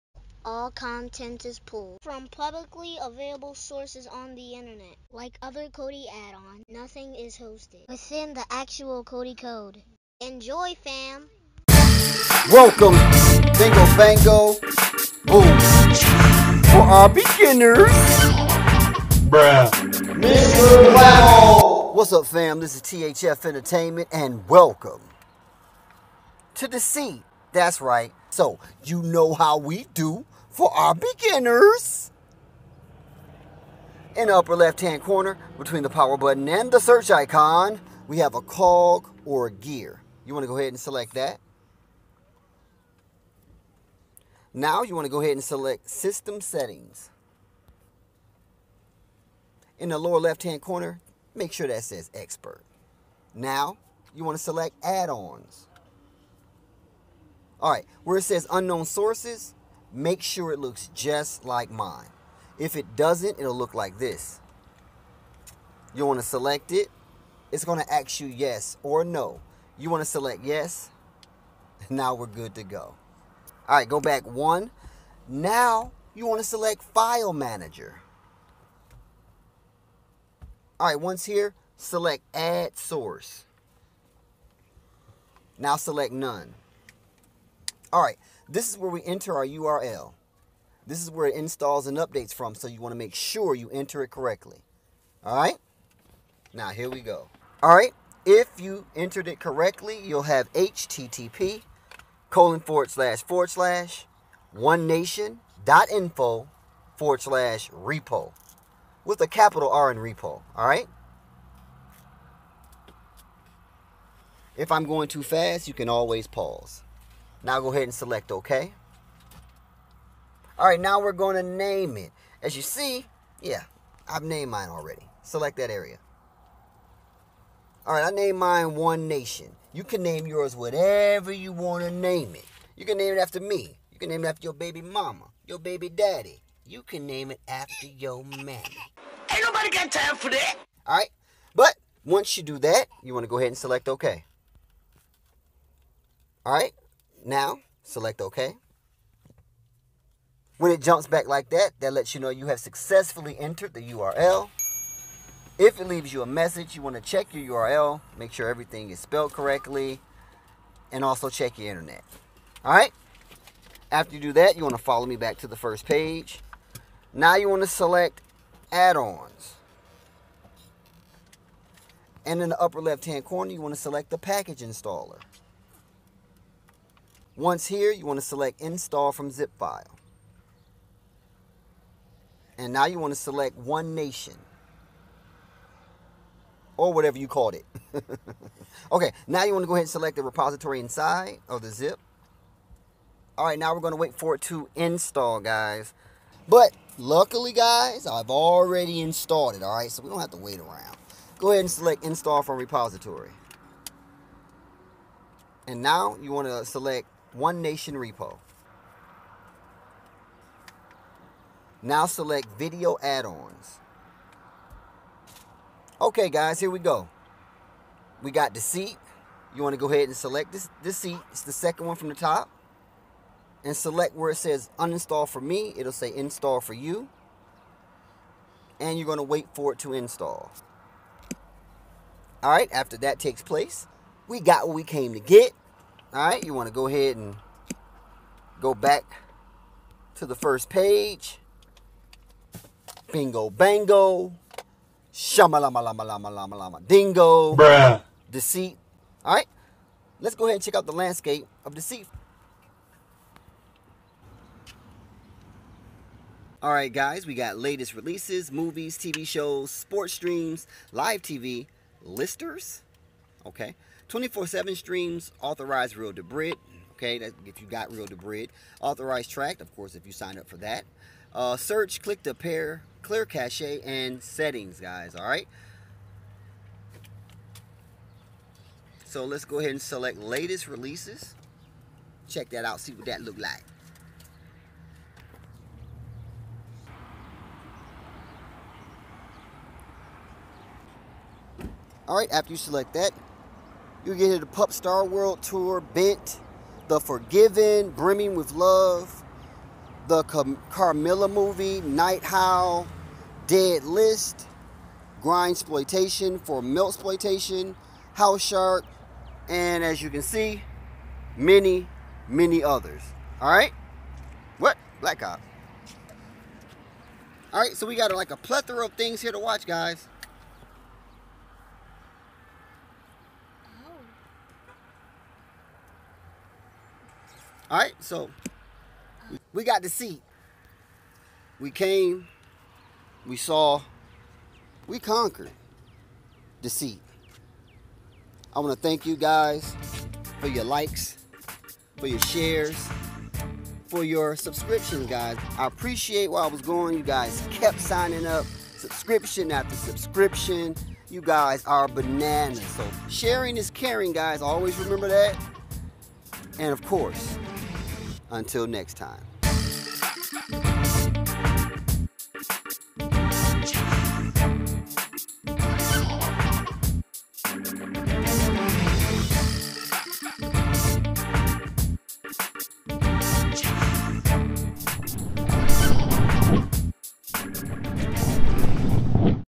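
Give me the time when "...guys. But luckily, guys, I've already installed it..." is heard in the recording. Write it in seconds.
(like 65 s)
195 s.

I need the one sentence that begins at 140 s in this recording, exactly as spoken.
All right, but once you do that, you want to go ahead and select OK.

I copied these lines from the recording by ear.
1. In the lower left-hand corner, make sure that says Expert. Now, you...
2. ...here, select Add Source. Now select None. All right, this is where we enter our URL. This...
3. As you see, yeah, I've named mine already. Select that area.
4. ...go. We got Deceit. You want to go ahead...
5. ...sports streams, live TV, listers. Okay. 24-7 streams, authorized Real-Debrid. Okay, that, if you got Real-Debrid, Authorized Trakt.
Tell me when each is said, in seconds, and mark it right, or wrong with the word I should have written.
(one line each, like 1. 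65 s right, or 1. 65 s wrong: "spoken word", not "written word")
1. 49 s right
2. 81 s right
3. 122 s right
4. 216 s right
5. 259 s right.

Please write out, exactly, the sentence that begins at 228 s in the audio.
And you're going to wait for it to install.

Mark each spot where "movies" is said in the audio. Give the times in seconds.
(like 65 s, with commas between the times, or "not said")
258 s, 301 s.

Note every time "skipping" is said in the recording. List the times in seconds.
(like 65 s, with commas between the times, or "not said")
not said.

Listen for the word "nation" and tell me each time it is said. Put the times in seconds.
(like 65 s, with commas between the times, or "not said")
104 s, 129 s, 183 s, 207 s.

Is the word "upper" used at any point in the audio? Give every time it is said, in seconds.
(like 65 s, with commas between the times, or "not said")
34 s, 172 s.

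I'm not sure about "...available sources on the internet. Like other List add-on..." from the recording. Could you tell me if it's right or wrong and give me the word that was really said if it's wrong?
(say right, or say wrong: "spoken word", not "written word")
wrong: "Kodi", not "List".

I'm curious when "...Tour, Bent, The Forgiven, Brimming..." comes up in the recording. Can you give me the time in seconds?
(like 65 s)
295 s.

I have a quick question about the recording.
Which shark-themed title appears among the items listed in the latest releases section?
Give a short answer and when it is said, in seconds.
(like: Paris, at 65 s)
House Shark, at 308 s.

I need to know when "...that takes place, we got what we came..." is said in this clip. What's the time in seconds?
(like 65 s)
232 s.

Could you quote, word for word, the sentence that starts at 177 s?
Once here, you want to select install from zip file.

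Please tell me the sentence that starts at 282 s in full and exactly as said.
Check that out, see what that look like.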